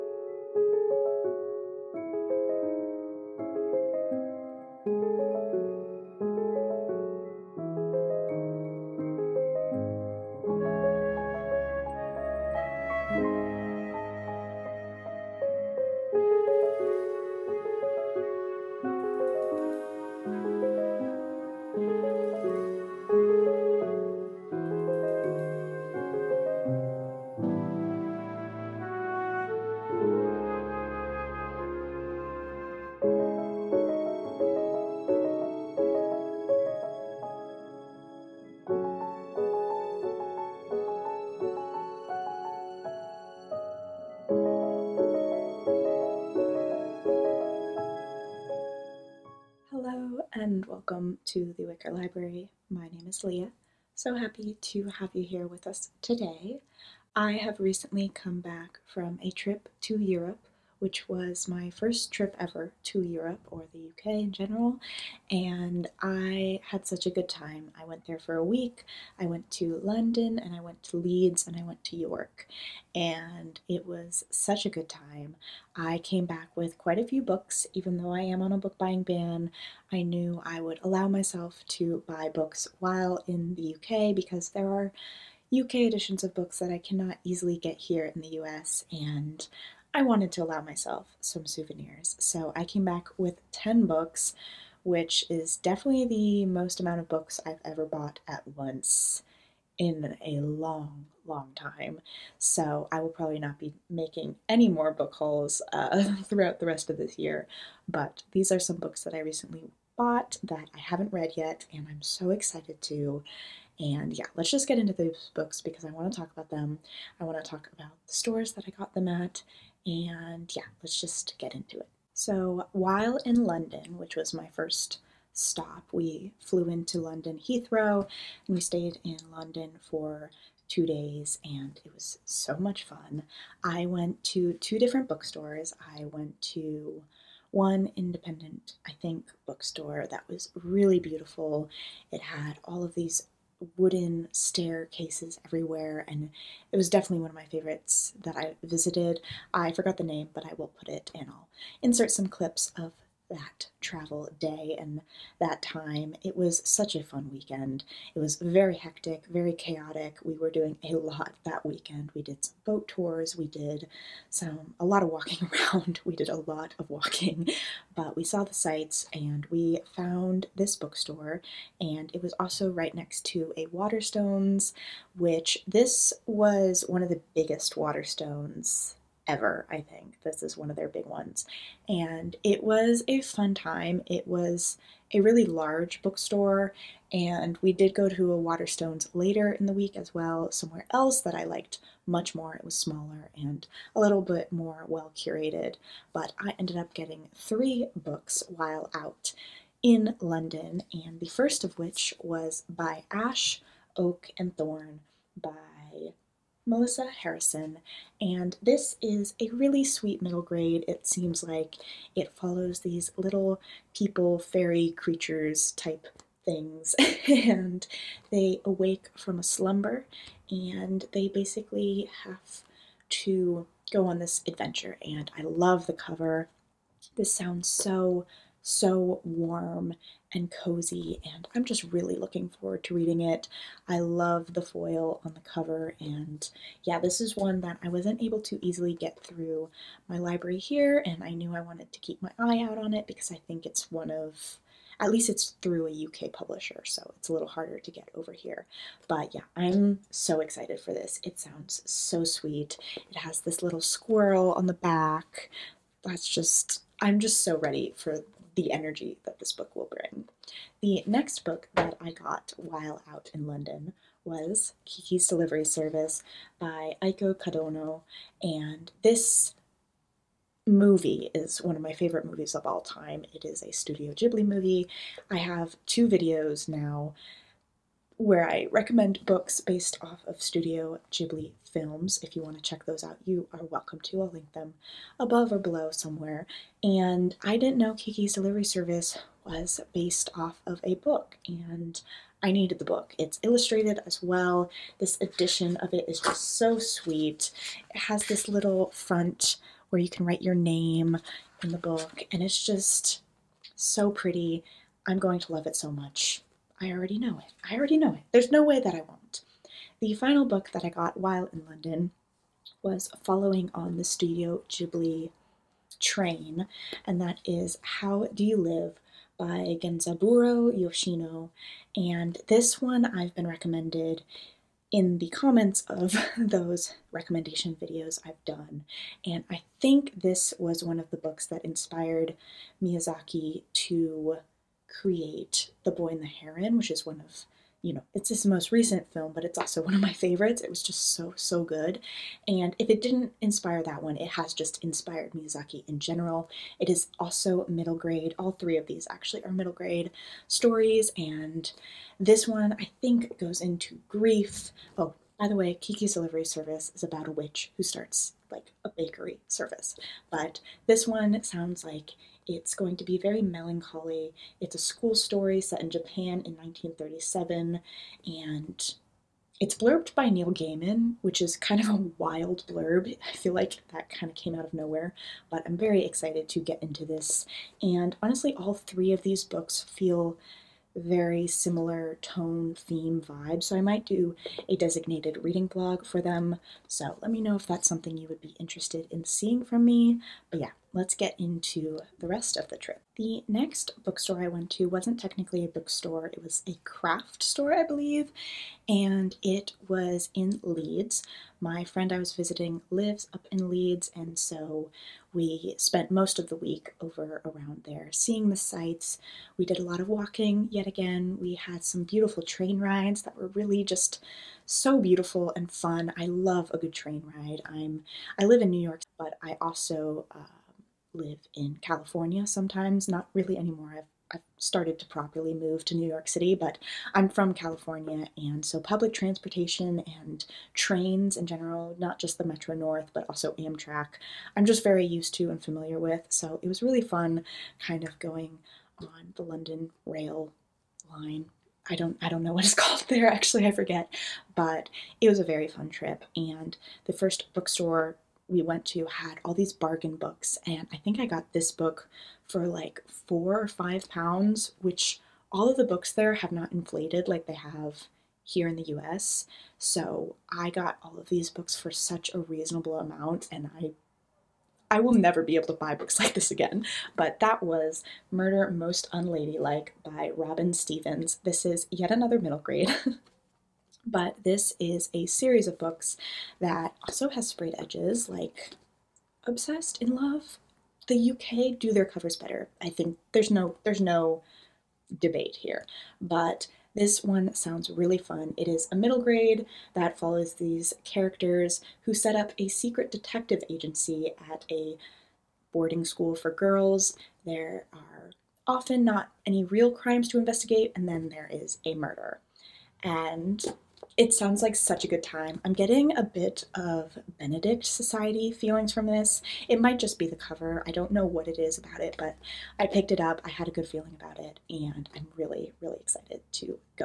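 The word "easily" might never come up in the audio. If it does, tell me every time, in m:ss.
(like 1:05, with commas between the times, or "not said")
1:27, 3:58.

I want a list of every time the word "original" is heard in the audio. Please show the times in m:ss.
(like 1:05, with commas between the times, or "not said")
not said.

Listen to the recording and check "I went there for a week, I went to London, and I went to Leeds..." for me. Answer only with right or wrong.
right.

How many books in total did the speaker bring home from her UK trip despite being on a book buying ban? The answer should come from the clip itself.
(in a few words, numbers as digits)
10.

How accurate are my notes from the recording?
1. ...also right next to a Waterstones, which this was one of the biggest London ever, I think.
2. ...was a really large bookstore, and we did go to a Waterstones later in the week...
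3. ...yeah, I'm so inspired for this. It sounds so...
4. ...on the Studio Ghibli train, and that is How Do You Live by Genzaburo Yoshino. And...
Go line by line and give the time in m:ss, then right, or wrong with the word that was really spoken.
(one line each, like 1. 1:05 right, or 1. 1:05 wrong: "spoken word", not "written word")
1. 2:52 wrong: "Waterstones", not "London"
2. 3:04 right
3. 4:09 wrong: "excited", not "inspired"
4. 5:13 right.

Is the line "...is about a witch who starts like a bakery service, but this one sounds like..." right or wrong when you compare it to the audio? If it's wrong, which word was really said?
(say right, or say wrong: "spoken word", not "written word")
right.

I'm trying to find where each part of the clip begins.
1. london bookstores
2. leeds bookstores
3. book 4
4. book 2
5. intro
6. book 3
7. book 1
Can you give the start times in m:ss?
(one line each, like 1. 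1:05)
1. 2:06
2. 6:33
3. 7:47
4. 4:20
5. 0:49
6. 5:10
7. 3:21.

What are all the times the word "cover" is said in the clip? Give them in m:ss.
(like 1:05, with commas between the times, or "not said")
3:45, 3:55, 8:02, 8:30.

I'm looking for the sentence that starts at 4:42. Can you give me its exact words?
If you want to check those out, you are welcome to.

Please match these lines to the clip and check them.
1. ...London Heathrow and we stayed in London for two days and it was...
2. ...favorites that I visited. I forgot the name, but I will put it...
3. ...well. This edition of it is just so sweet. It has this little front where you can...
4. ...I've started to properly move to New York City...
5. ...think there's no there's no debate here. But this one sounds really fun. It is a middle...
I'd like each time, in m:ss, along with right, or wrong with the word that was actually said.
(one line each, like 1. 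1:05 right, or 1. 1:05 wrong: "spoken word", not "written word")
1. 2:06 right
2. 2:27 right
3. 4:54 right
4. 7:04 right
5. 8:02 right.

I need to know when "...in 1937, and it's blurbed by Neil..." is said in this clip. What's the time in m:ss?
6:06.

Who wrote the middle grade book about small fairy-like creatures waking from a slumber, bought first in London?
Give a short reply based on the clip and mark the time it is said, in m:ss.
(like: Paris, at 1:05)
Melissa Harrison, at 3:26.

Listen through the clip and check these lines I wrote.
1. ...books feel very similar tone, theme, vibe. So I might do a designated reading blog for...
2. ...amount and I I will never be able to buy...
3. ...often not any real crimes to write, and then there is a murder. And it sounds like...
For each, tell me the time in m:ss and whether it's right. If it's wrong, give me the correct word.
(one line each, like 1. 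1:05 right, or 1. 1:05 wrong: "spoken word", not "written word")
1. 6:19 right
2. 7:42 right
3. 8:18 wrong: "investigate", not "write".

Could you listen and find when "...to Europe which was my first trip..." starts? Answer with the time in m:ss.
0:59.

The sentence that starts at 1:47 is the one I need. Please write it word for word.
But these are some books that I recently bought that I haven't read yet, and I'm so excited to.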